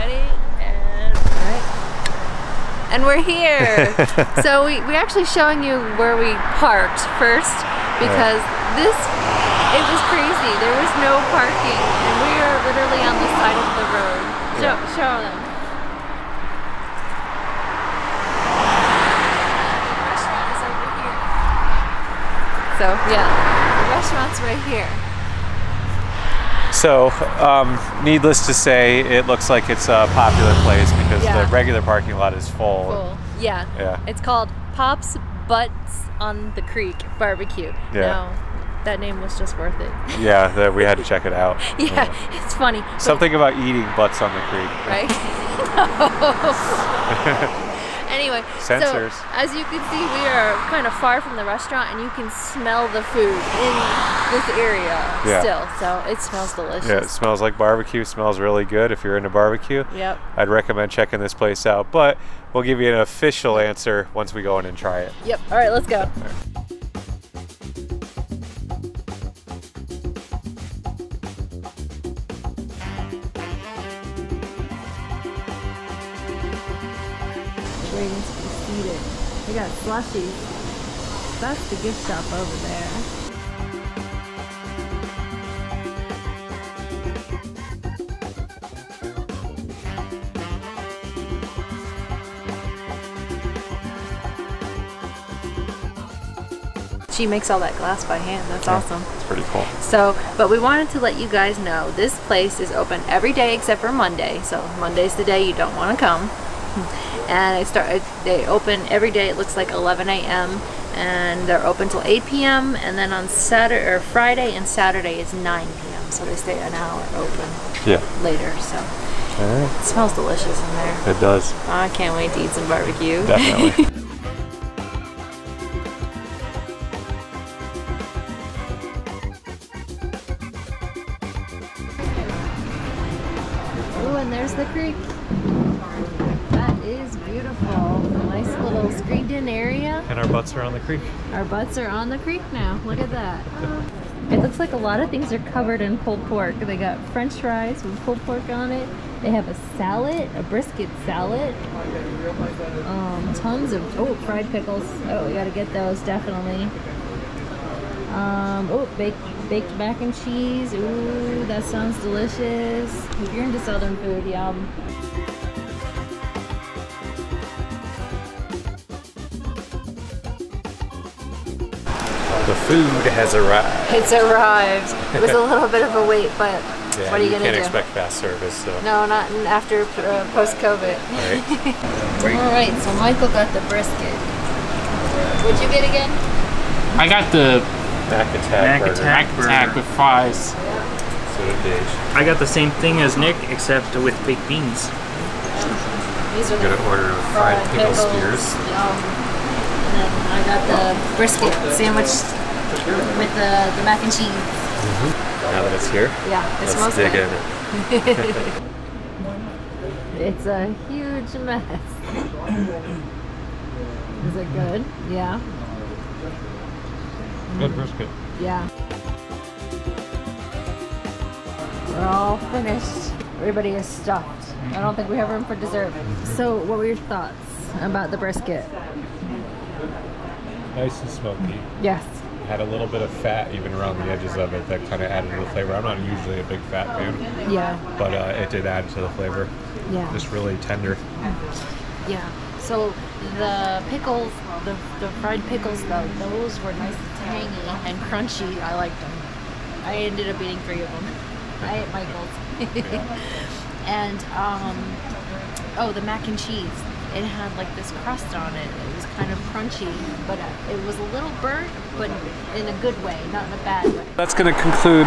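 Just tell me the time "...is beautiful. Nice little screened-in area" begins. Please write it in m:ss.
2:16.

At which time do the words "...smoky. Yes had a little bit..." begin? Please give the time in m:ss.
3:51.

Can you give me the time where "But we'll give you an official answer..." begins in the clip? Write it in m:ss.
1:01.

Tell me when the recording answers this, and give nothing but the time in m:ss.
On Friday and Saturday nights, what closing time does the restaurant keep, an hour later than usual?
1:55.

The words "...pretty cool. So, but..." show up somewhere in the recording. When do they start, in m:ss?
1:39.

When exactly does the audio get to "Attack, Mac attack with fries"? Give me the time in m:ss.
3:08.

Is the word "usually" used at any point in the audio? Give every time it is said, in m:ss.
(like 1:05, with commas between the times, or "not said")
3:55.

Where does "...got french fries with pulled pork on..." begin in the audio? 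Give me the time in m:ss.
2:26.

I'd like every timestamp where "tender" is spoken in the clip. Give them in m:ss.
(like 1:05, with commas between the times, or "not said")
4:00.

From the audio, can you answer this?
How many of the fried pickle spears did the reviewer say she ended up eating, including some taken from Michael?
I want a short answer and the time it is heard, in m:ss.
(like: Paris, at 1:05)
3, at 4:10.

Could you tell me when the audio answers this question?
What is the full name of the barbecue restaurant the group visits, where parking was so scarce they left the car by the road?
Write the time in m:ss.
0:34.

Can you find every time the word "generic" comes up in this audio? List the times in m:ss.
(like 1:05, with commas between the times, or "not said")
not said.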